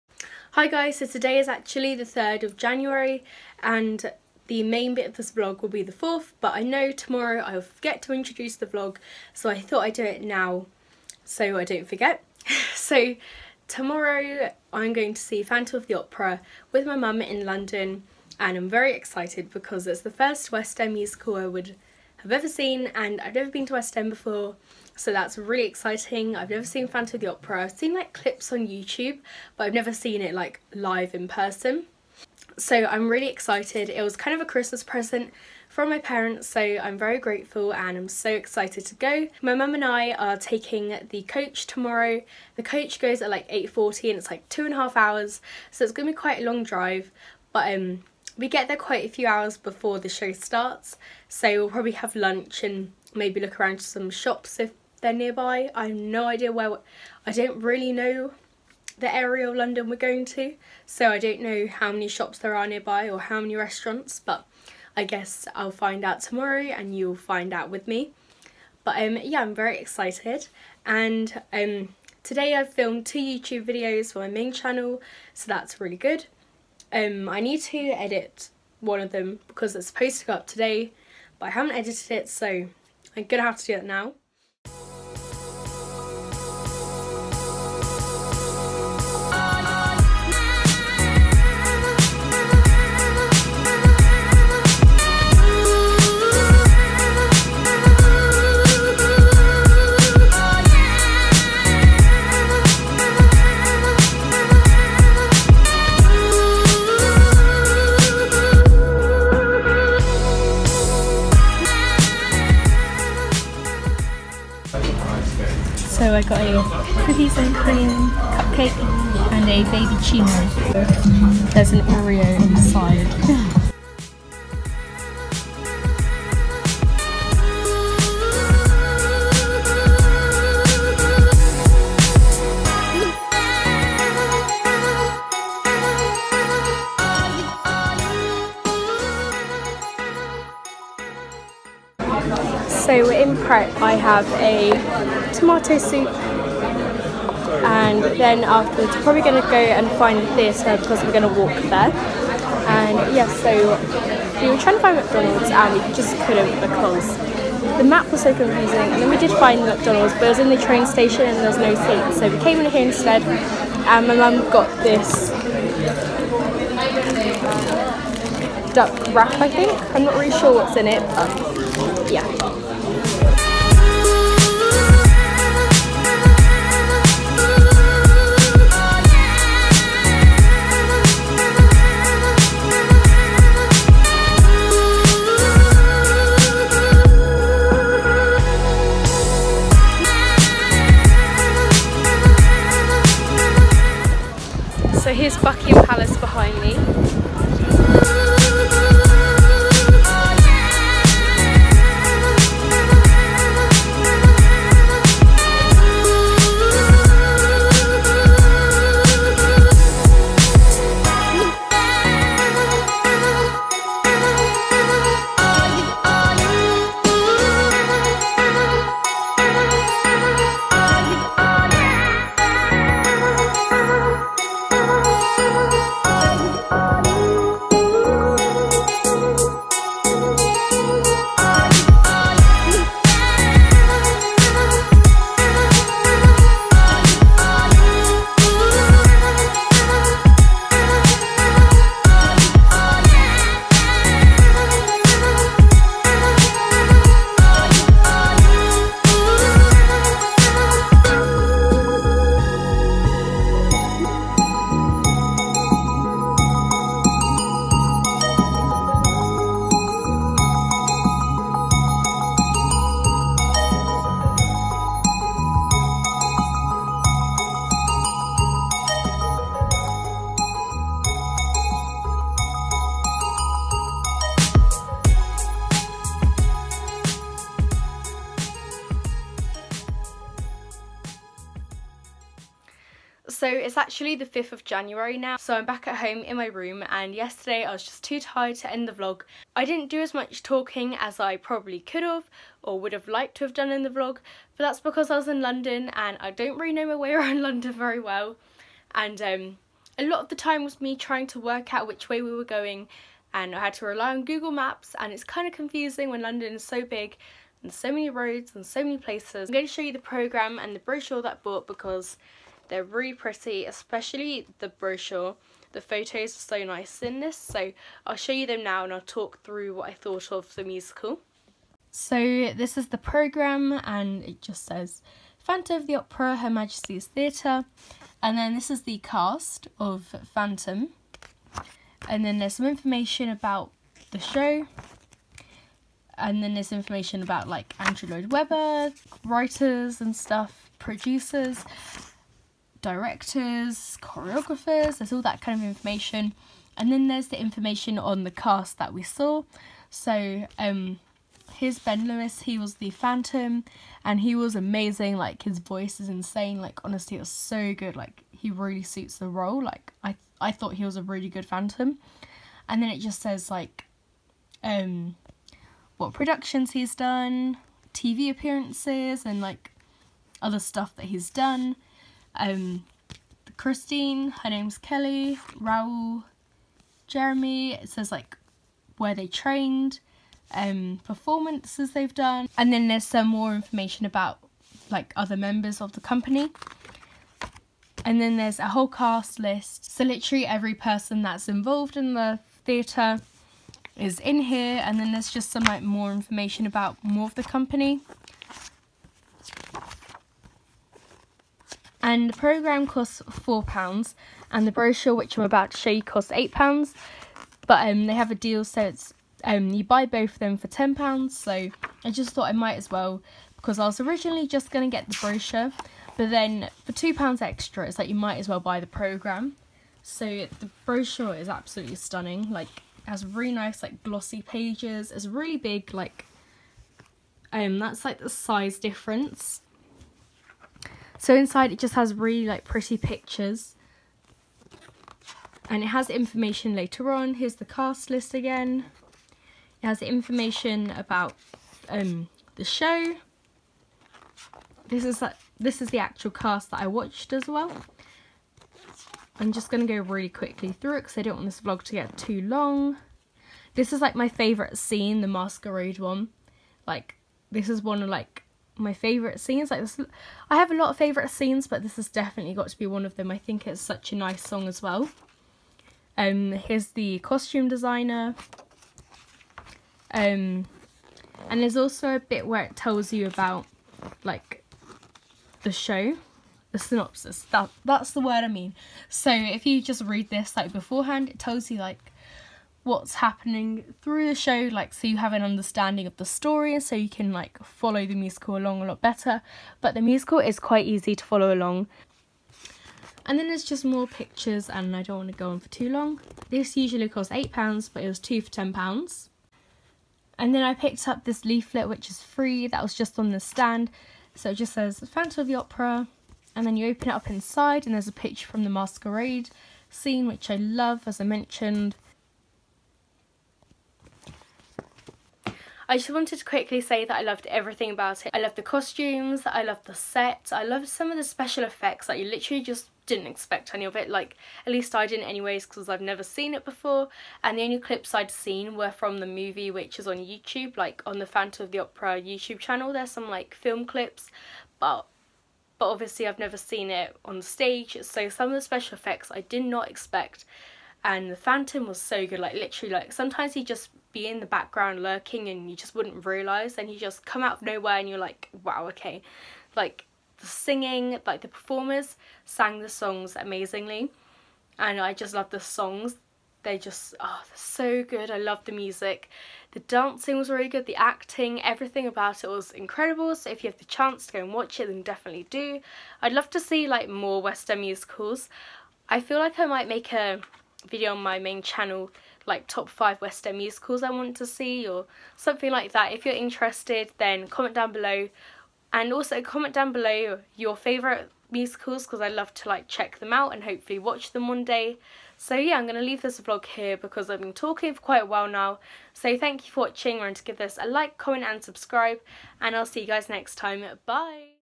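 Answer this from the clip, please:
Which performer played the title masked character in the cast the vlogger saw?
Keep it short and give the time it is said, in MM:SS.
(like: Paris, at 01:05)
Ben Lewis, at 05:51.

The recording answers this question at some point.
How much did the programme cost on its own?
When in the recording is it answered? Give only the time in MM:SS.
06:43.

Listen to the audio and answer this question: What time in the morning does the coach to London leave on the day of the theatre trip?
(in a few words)
8.40.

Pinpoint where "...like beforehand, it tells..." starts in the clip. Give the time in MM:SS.
08:00.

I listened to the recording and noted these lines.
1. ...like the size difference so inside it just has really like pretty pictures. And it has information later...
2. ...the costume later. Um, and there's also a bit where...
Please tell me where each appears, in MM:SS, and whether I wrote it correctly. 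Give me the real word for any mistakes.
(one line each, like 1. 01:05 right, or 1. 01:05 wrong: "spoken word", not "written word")
1. 07:08 right
2. 07:46 wrong: "designer", not "later".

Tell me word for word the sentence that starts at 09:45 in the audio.
So yeah, I'm going to leave this vlog here because I've been talking for quite a while now.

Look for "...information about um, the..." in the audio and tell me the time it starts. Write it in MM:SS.
07:20.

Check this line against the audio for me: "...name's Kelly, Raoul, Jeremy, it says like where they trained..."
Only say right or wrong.
right.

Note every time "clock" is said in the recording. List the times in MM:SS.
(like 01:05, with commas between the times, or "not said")
not said.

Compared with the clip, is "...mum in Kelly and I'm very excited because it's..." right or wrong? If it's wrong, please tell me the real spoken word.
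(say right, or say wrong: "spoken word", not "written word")
wrong: "London", not "Kelly".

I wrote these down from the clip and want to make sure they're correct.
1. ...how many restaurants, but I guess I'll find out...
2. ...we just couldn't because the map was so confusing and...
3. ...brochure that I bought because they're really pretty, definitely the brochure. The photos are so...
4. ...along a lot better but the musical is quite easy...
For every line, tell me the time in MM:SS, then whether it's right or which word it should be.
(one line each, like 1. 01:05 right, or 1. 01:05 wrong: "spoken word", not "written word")
1. 01:03 right
2. 02:35 right
3. 05:10 wrong: "especially", not "definitely"
4. 08:08 right.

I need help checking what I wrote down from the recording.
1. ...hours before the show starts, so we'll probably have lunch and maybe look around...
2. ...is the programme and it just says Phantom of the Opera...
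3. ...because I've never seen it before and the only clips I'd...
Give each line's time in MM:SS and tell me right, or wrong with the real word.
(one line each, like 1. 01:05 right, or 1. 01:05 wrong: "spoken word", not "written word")
1. 00:49 right
2. 05:22 right
3. 08:45 right.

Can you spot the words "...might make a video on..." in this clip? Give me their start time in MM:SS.
09:29.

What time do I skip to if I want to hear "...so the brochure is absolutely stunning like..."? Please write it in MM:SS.
07:00.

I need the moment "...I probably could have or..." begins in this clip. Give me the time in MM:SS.
04:51.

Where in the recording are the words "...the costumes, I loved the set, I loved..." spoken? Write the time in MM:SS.
08:38.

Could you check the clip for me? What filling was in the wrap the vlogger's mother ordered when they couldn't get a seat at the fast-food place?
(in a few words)
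duck.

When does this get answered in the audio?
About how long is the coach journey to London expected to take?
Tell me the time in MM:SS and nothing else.
00:44.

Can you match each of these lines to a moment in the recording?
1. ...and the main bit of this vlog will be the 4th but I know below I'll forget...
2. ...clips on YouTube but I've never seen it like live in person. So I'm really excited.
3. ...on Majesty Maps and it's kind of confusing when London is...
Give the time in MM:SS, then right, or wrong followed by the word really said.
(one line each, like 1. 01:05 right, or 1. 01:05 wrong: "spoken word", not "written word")
1. 00:03 wrong: "tomorrow", not "below"
2. 00:28 right
3. 05:04 wrong: "Google", not "Majesty".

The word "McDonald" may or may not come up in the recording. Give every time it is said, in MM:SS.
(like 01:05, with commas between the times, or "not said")
02:34, 02:39.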